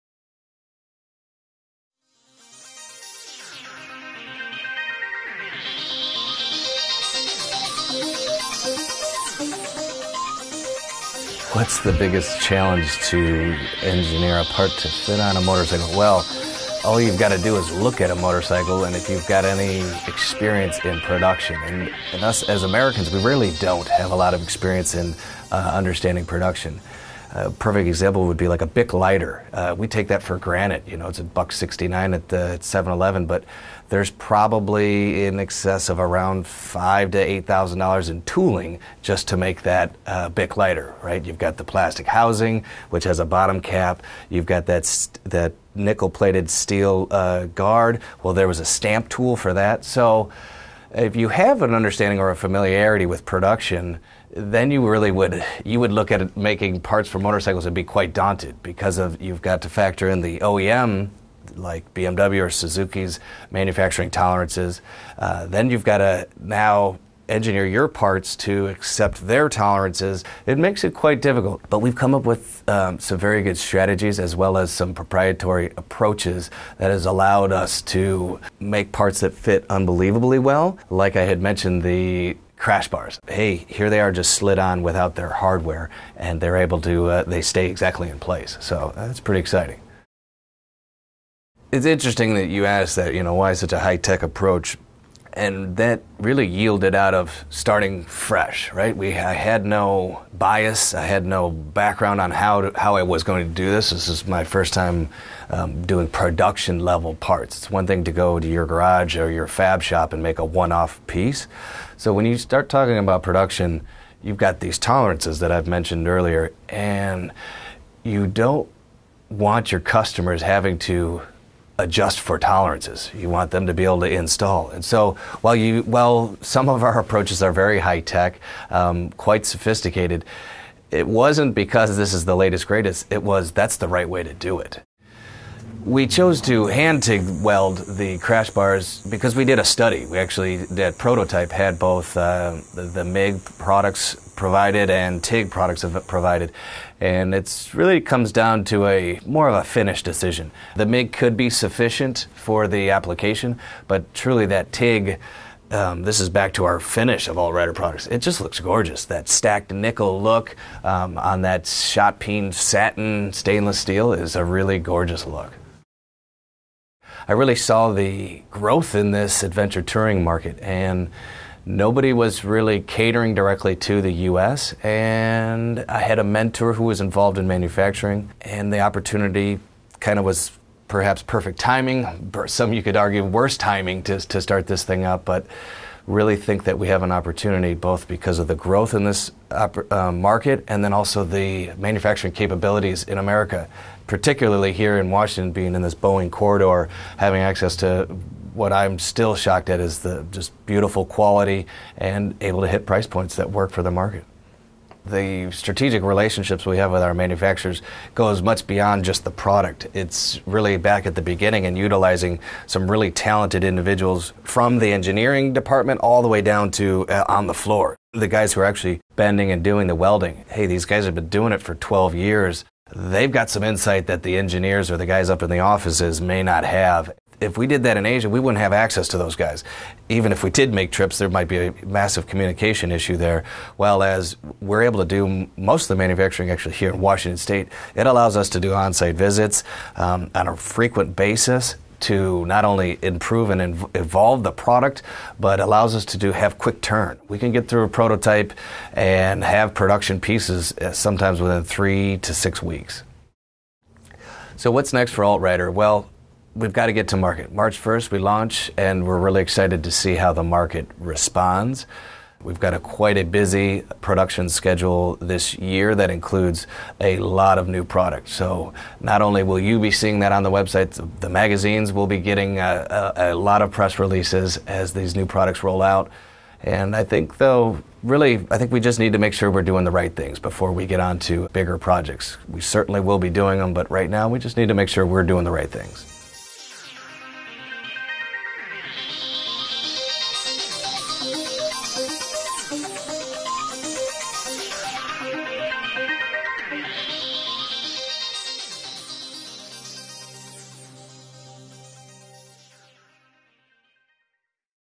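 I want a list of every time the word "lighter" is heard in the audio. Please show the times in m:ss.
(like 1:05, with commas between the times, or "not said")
0:28, 0:40.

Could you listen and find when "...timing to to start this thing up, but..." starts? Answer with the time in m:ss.
3:03.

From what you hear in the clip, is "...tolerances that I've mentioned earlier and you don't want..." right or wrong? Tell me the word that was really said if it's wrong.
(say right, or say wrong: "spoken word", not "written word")
right.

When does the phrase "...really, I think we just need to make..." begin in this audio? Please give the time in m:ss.
4:38.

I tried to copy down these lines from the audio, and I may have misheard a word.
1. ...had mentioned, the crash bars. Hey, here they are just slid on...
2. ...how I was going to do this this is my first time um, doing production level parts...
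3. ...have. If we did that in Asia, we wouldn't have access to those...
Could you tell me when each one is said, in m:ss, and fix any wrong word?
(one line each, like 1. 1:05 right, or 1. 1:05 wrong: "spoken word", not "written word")
1. 1:21 right
2. 1:42 right
3. 3:46 right.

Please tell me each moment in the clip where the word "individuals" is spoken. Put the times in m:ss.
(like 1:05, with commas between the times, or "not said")
3:33.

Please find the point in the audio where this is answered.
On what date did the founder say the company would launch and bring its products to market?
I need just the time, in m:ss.
4:17.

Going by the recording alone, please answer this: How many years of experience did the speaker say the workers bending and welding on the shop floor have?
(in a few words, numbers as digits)
12 years.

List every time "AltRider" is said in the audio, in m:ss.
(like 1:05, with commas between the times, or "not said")
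2:37, 4:15.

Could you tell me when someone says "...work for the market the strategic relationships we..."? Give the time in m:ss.
3:23.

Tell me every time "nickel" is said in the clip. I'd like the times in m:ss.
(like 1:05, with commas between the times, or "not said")
0:45, 2:39.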